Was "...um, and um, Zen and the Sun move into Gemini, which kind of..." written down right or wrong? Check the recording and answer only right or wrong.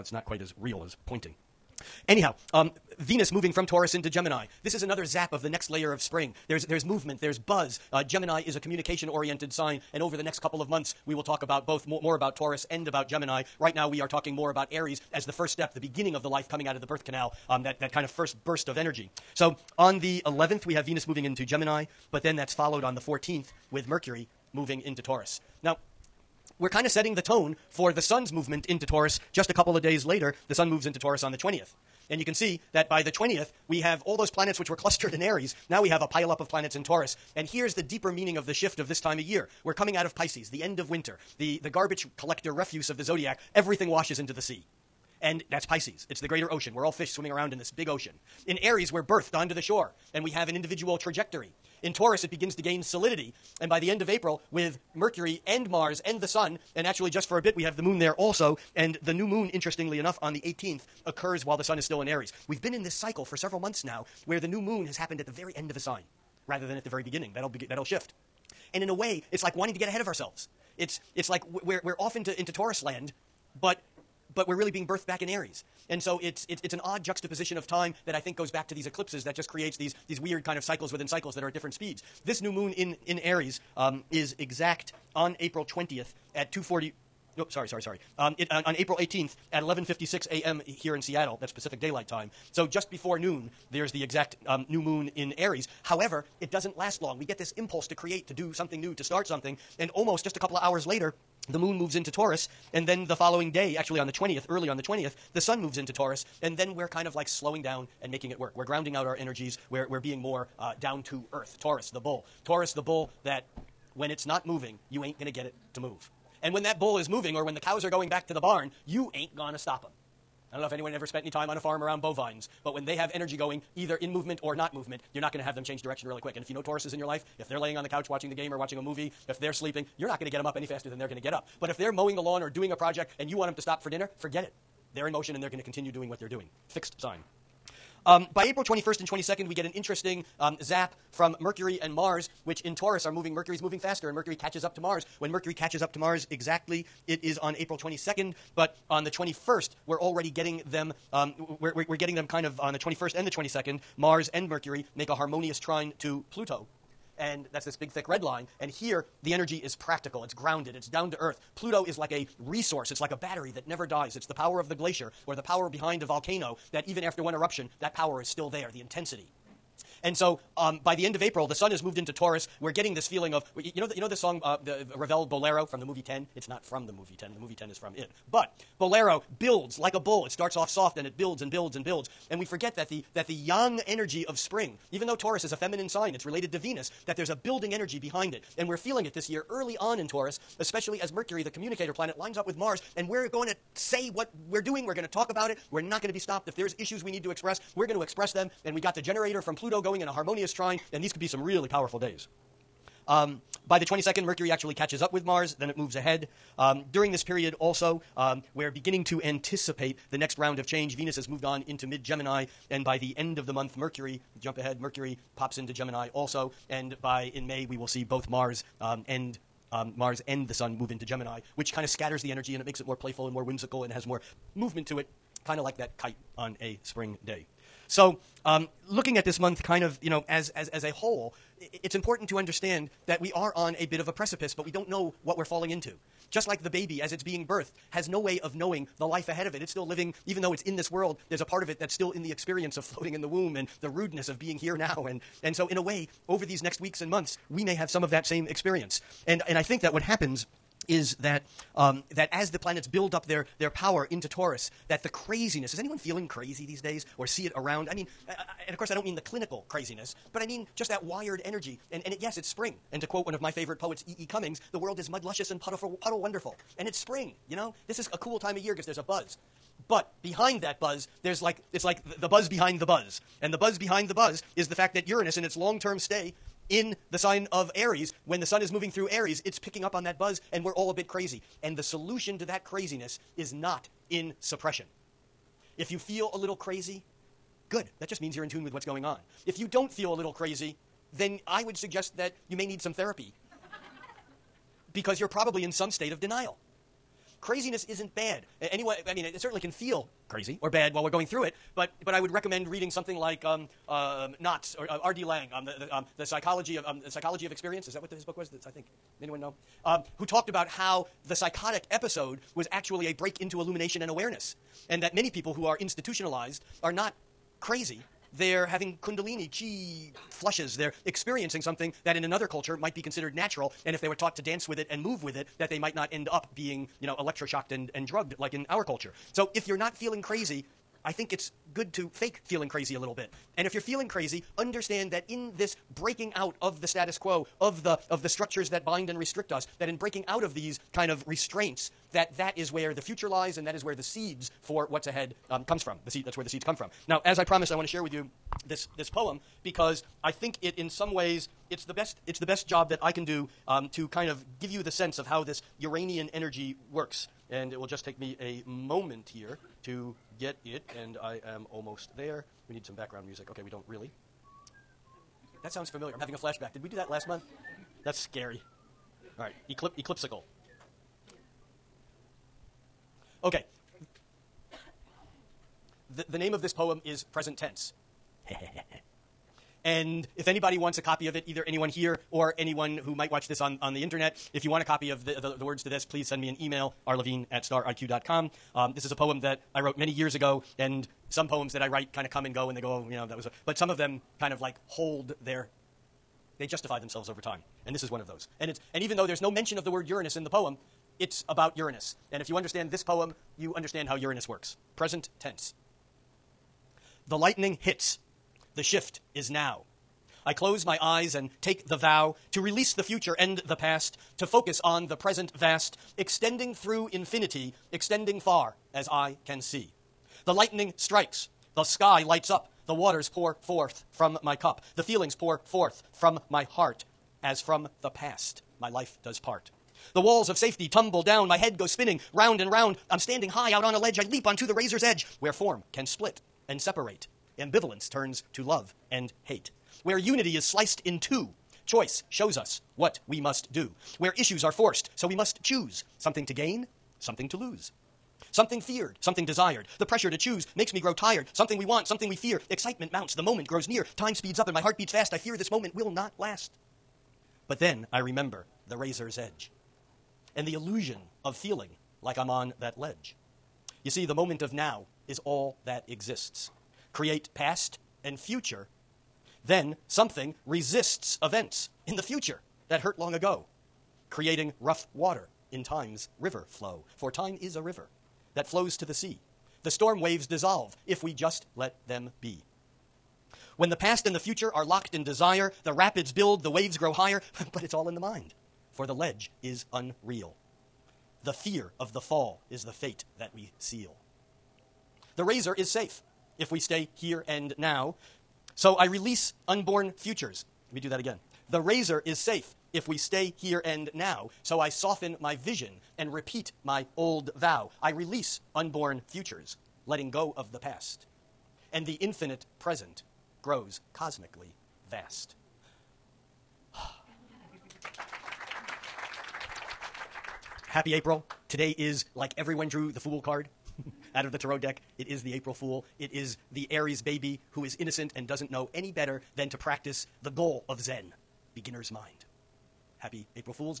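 wrong.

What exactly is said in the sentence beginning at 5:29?
So if you're not feeling crazy, I think it's good to fake feeling crazy a little bit.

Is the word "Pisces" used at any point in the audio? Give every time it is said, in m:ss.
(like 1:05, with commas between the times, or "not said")
0:40, 0:45.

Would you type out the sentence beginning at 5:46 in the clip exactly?
The seed, that's where the seeds come from.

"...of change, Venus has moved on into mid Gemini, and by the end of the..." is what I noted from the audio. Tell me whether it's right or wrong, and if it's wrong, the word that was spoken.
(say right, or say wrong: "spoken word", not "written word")
right.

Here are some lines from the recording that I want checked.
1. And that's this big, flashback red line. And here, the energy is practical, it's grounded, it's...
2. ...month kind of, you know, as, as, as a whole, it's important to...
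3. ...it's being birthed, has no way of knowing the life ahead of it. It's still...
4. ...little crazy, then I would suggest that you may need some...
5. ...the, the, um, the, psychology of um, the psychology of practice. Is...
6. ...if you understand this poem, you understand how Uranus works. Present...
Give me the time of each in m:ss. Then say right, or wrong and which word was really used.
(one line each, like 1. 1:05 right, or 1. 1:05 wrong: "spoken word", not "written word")
1. 2:37 wrong: "thick", not "flashback"
2. 3:49 right
3. 3:57 right
4. 4:50 right
5. 5:05 wrong: "experience", not "practice"
6. 6:42 right.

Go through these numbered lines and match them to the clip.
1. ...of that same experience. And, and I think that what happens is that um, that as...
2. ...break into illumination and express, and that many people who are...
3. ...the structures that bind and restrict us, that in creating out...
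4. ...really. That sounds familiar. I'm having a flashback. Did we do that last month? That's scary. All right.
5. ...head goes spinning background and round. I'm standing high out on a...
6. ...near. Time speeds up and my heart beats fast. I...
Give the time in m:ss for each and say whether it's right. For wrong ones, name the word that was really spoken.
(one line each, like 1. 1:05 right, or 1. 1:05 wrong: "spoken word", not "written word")
1. 4:08 right
2. 5:13 wrong: "awareness", not "express"
3. 5:38 wrong: "breaking", not "creating"
4. 6:03 right
5. 7:11 wrong: "round", not "background"
6. 7:33 right.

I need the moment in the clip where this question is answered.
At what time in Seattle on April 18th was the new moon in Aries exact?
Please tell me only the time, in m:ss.
1:29.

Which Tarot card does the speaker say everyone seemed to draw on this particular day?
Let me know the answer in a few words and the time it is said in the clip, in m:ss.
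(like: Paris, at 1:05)
The Fool, at 8:43.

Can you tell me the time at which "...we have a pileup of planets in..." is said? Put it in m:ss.
0:35.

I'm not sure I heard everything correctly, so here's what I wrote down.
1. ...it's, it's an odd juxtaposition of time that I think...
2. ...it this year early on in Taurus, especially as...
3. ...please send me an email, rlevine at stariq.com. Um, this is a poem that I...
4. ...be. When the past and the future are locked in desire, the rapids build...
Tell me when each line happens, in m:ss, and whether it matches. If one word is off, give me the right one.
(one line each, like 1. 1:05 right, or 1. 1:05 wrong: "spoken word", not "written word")
1. 1:16 right
2. 3:09 right
3. 6:26 right
4. 8:02 right.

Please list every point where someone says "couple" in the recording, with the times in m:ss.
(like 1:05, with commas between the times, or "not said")
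0:10, 0:29, 1:40.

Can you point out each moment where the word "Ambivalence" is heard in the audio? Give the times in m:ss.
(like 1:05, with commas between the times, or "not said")
7:17.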